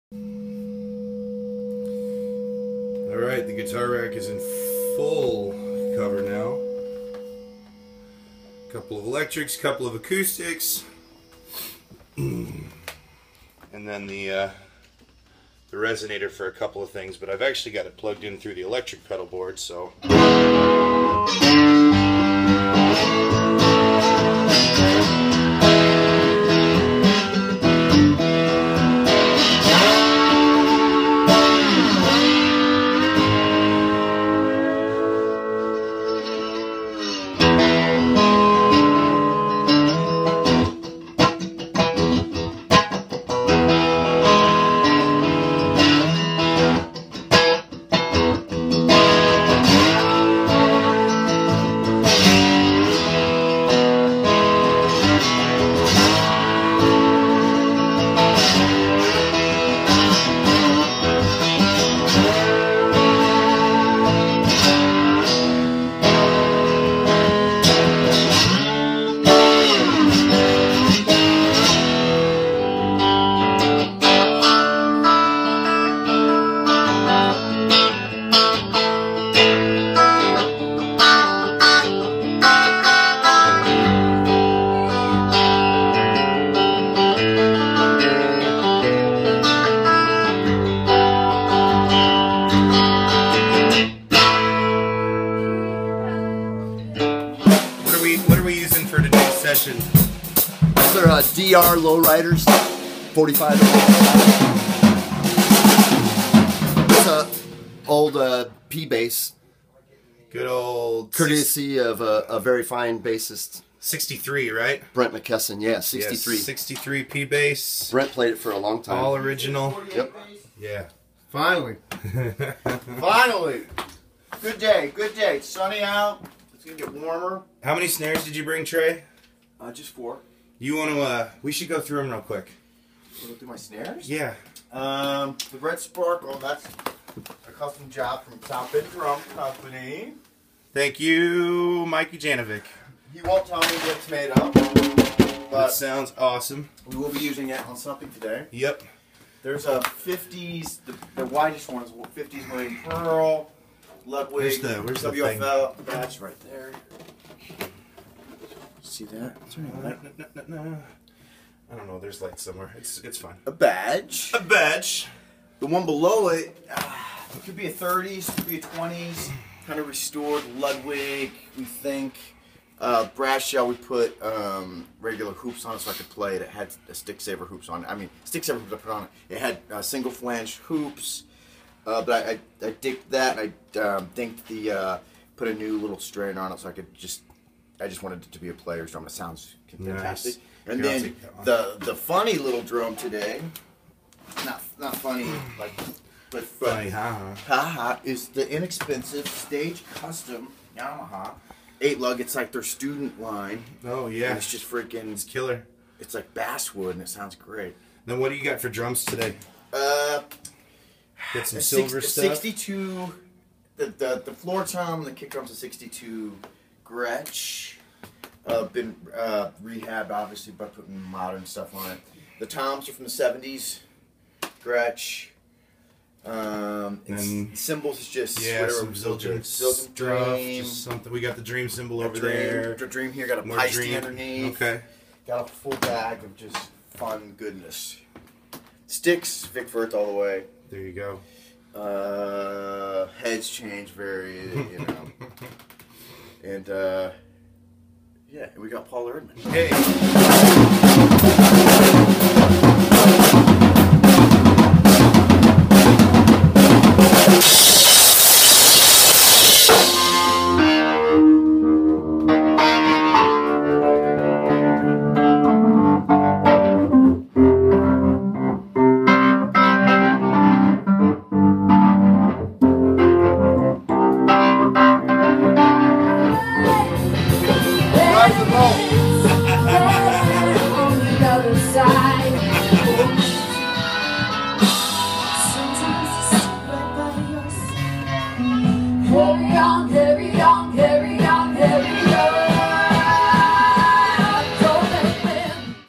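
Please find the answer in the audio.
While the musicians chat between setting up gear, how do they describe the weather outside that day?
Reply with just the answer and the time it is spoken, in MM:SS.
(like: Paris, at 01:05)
Sunny, at 02:05.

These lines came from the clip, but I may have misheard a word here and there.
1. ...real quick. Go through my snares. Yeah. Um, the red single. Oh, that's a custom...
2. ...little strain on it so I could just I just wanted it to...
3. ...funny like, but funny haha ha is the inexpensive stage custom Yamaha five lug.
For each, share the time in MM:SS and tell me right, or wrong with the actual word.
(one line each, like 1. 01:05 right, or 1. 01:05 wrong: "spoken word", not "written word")
1. 02:12 wrong: "sparkle", not "single"
2. 03:05 right
3. 03:14 wrong: "eight", not "five".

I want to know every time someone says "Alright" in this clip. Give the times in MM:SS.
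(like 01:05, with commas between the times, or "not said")
00:03.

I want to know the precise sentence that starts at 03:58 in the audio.
Sticks, Vic Firth all the way.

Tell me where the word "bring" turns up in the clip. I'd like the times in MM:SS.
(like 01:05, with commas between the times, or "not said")
02:08.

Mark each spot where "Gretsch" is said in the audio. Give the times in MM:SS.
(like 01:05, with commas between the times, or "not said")
03:36, 03:44.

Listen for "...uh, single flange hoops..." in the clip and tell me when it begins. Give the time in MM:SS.
02:59.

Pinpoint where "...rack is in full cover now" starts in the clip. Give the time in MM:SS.
00:03.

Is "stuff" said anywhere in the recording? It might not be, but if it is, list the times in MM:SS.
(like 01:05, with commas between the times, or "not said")
03:32, 03:41, 03:49.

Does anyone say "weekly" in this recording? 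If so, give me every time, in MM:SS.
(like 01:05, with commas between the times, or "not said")
not said.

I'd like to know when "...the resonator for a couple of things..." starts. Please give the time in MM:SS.
00:15.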